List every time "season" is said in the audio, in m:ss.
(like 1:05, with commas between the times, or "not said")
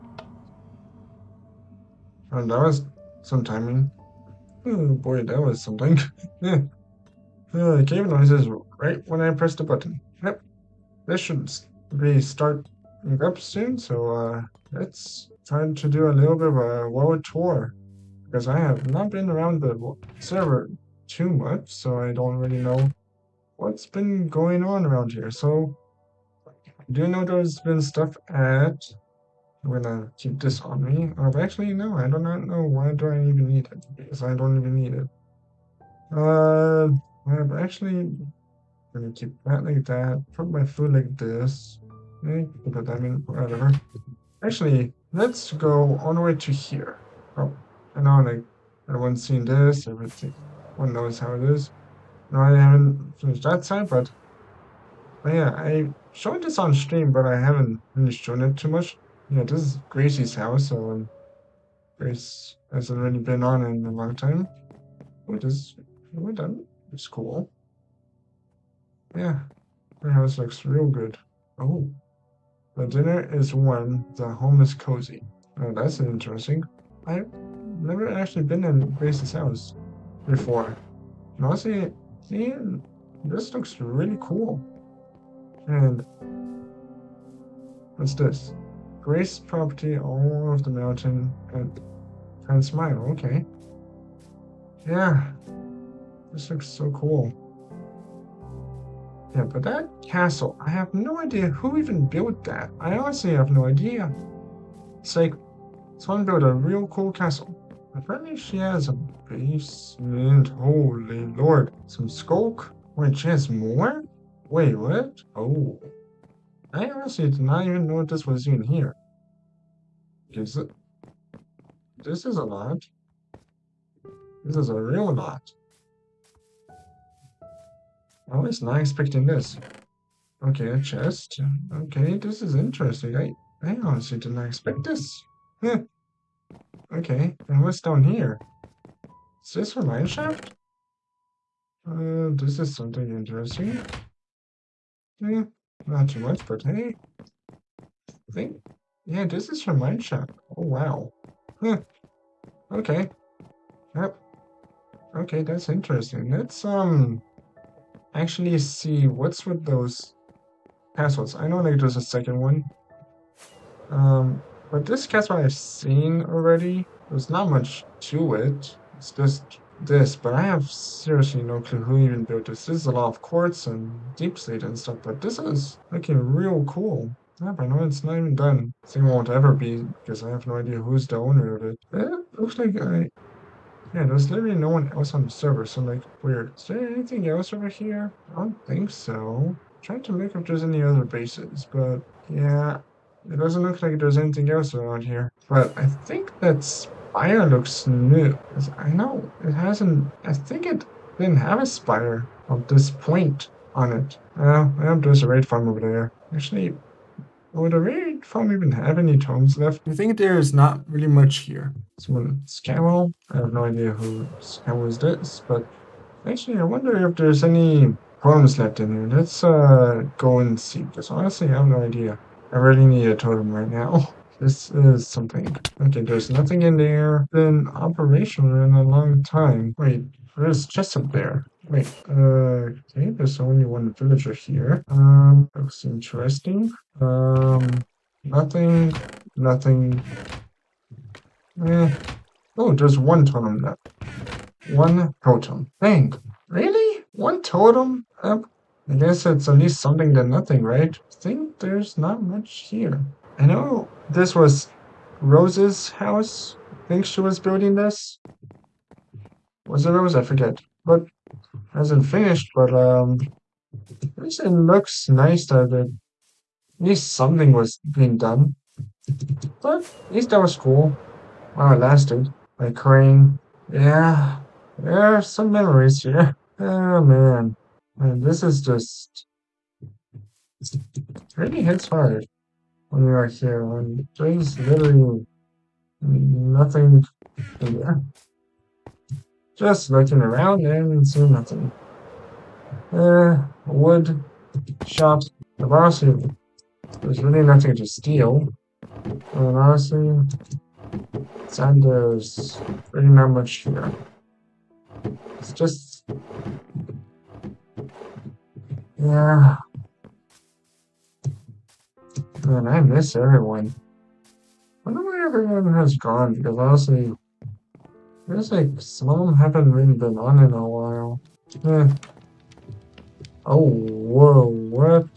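not said.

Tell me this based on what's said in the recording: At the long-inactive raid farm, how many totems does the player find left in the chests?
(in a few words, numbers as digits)
1.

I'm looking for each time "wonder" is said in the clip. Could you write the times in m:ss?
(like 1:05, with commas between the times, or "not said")
3:36, 5:14.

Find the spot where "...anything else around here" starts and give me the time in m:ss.
3:14.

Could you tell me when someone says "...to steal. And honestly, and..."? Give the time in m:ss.
4:57.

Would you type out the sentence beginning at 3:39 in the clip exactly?
Let's uh, go and see, because honestly, I have no idea.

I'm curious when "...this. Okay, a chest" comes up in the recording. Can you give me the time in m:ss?
2:09.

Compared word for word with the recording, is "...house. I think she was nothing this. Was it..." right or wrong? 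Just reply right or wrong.
wrong.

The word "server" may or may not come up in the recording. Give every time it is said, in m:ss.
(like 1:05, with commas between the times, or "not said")
0:20, 3:05.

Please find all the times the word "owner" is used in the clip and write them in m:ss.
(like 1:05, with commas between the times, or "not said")
3:01.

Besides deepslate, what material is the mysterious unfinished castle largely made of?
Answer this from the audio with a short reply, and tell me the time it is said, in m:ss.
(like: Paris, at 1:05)
Quartz, at 2:53.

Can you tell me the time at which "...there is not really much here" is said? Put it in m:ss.
3:30.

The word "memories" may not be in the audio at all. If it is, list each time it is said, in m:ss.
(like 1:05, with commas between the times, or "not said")
4:35.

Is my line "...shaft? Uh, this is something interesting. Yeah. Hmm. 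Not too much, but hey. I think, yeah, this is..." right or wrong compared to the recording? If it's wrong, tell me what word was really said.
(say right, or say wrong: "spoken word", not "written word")
right.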